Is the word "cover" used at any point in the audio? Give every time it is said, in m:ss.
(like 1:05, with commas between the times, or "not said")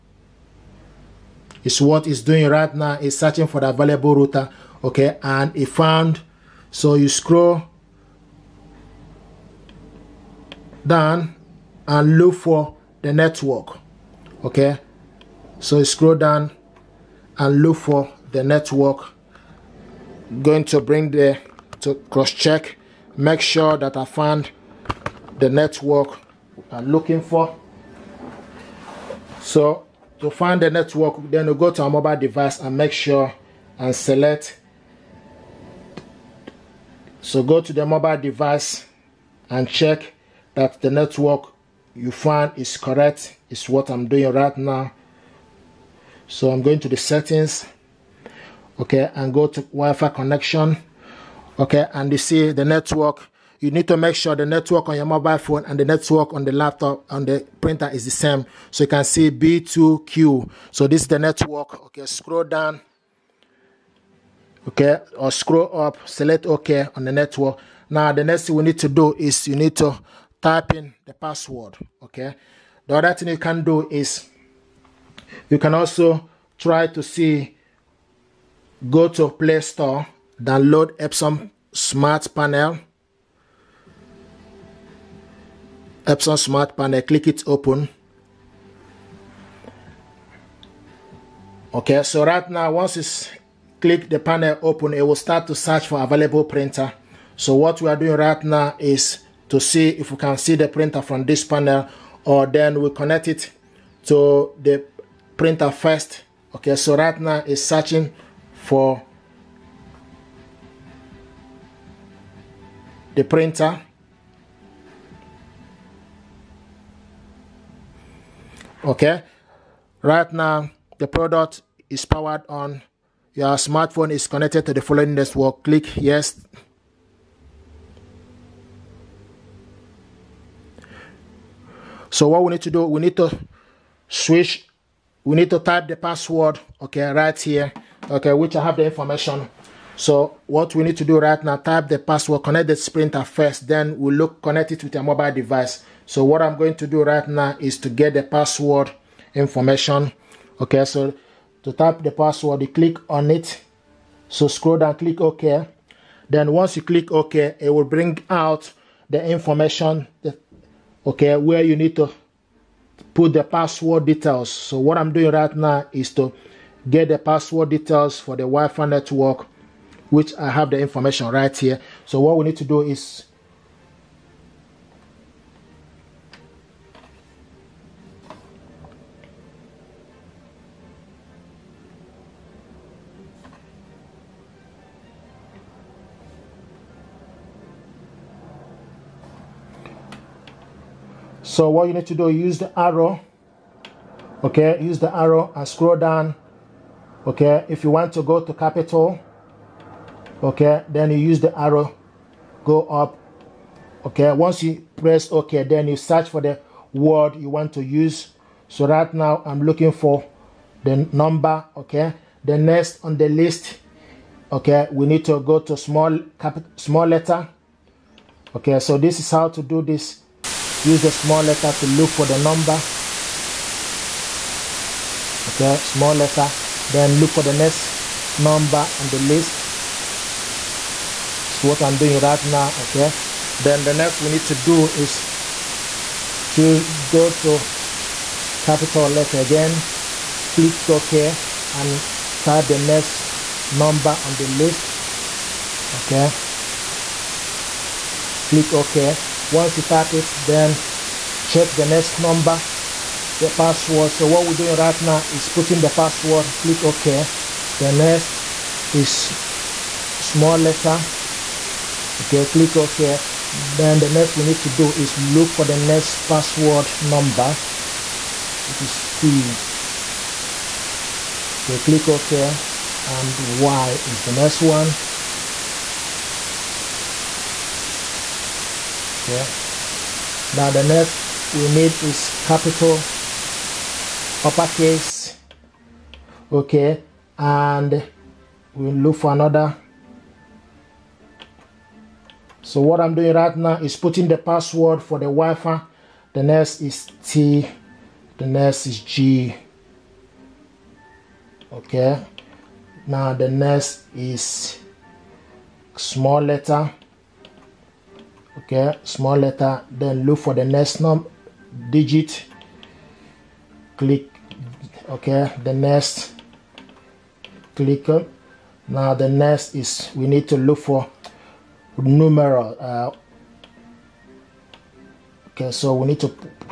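not said.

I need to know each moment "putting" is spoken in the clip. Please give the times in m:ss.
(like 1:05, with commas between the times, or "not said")
4:15, 4:53.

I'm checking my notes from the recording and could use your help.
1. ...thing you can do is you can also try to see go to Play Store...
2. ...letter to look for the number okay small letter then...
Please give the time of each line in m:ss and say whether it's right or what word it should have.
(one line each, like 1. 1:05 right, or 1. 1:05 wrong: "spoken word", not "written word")
1. 1:13 right
2. 3:41 right.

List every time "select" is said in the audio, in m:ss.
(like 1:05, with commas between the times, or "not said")
0:33, 1:06.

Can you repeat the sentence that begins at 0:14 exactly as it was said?
Okay, so you scroll down and look for the network.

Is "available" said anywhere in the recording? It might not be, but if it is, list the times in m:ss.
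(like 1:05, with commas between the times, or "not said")
0:03, 1:36.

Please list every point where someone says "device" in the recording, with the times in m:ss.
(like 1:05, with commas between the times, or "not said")
0:32, 0:38, 2:25.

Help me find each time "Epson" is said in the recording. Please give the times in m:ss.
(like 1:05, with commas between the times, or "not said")
1:20, 1:26.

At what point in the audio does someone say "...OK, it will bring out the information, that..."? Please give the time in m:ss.
2:37.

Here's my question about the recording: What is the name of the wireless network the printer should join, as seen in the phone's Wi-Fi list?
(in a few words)
B2Q.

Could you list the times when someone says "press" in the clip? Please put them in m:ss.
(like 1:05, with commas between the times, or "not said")
3:24.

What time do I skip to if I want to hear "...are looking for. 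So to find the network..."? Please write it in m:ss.
0:26.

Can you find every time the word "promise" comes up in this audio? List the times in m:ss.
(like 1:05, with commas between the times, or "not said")
not said.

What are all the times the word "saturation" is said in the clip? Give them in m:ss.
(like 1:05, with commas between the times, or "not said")
not said.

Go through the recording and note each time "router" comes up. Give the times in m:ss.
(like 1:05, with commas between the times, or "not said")
0:04.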